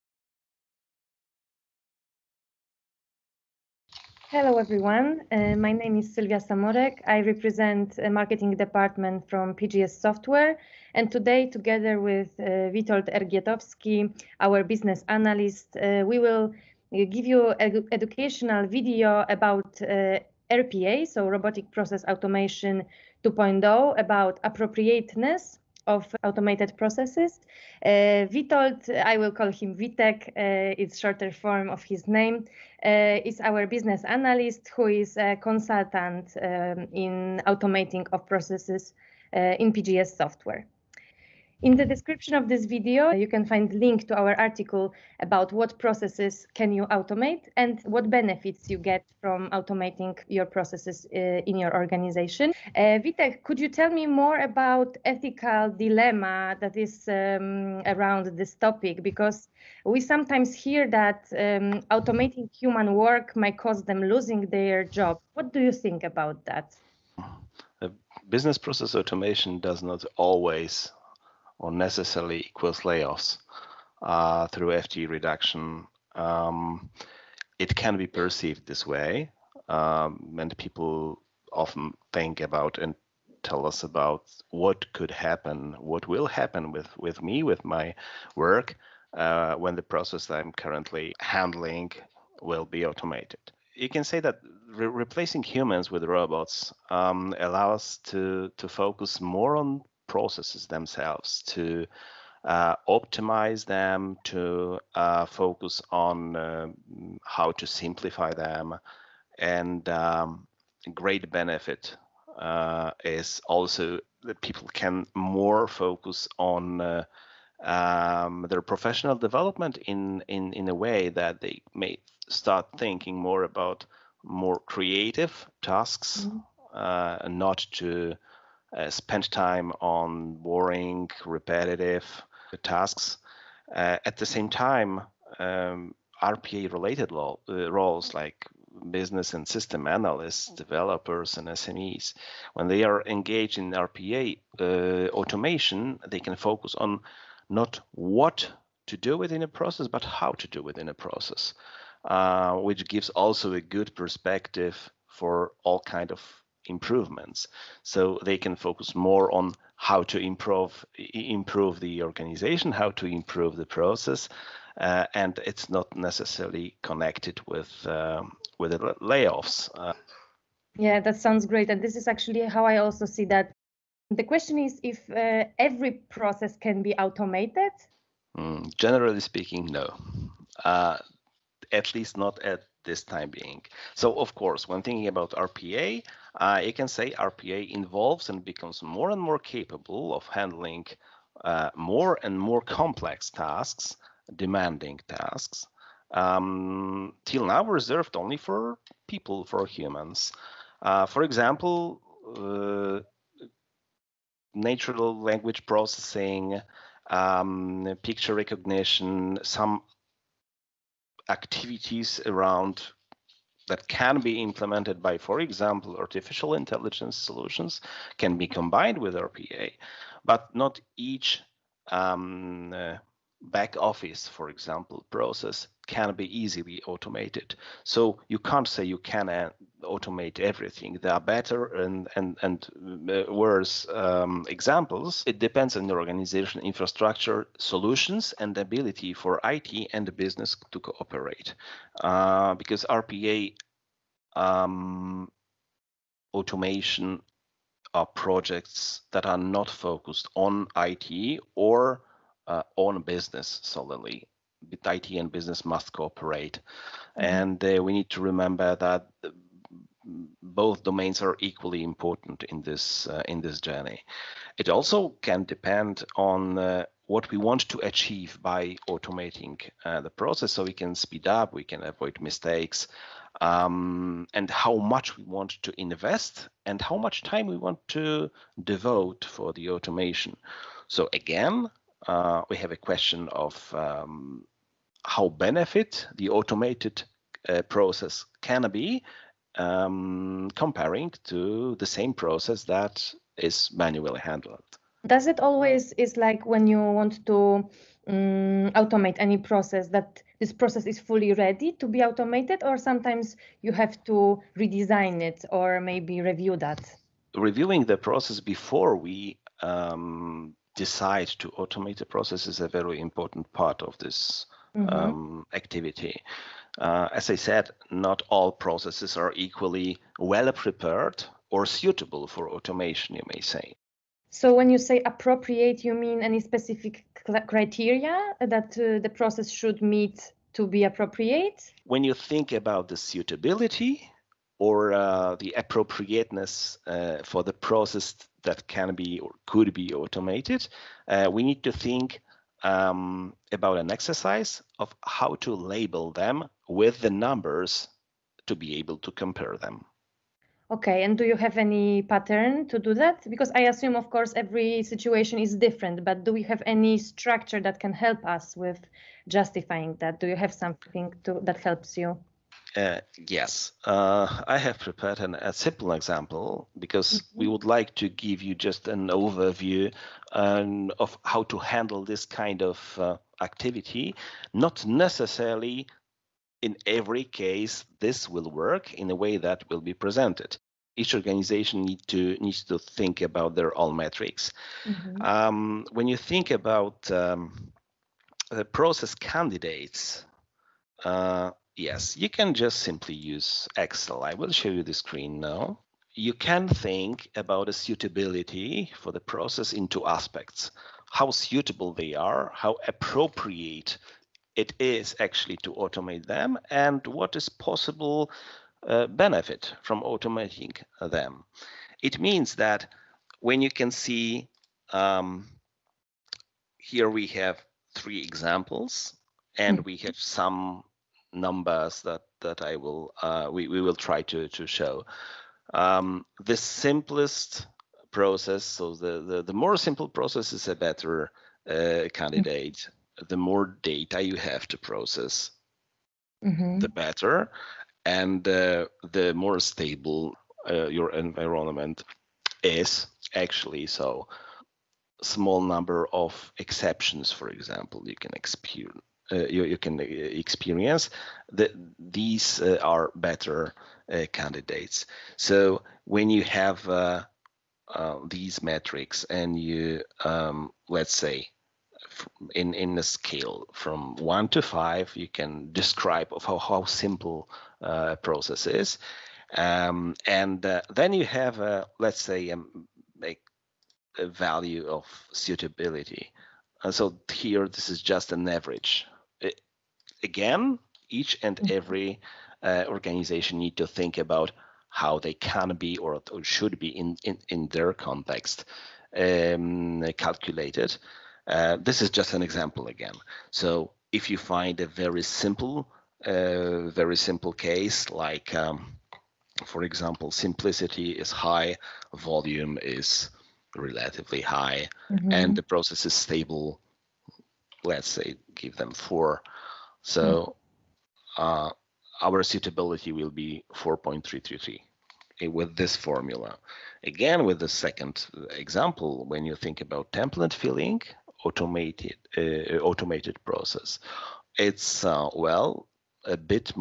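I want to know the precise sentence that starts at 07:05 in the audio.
Um, the simplest process, so the, the, the more simple process is a better uh, mm.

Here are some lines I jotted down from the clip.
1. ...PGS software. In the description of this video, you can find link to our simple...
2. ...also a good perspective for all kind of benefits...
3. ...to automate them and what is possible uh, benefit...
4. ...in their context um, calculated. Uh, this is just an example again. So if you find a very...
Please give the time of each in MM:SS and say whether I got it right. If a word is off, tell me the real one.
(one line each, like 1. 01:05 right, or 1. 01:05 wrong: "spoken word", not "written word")
1. 00:39 wrong: "article", not "simple"
2. 02:33 wrong: "improvements", not "benefits"
3. 06:45 right
4. 08:07 right.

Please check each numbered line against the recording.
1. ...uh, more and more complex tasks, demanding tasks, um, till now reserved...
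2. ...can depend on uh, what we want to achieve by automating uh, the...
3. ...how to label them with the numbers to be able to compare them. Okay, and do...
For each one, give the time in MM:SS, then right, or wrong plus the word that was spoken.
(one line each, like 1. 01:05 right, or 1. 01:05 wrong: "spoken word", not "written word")
1. 03:11 right
2. 04:25 right
3. 05:45 right.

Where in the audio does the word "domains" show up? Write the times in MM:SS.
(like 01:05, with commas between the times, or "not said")
04:20.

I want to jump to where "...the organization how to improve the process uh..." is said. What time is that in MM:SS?
02:41.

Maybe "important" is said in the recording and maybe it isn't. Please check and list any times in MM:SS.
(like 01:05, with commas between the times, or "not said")
04:21, 05:13.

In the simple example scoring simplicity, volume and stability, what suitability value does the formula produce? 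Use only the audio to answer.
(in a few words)
4.333.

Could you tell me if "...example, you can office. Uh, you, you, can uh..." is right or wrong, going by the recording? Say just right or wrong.
wrong.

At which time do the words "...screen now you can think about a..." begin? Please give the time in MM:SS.
06:34.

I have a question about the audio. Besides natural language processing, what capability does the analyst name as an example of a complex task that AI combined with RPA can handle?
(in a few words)
Picture recognition.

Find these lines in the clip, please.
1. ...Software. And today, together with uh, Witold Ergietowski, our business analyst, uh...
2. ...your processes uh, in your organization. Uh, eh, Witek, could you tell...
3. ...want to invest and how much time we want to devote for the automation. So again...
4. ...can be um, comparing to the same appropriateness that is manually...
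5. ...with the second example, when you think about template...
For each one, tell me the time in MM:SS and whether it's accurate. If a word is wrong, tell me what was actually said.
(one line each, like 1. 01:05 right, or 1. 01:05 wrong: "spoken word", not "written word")
1. 00:10 right
2. 00:50 right
3. 04:35 right
4. 04:48 wrong: "process", not "appropriateness"
5. 08:37 right.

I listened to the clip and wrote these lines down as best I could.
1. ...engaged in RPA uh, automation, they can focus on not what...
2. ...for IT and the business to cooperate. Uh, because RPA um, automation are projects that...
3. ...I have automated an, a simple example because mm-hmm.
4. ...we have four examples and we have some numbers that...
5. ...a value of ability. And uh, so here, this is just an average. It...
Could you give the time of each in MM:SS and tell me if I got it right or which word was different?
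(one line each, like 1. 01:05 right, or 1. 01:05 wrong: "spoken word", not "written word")
1. 02:23 right
2. 03:59 right
3. 06:04 wrong: "prepared", not "automated"
4. 06:57 wrong: "three", not "four"
5. 07:54 wrong: "suitability", not "ability".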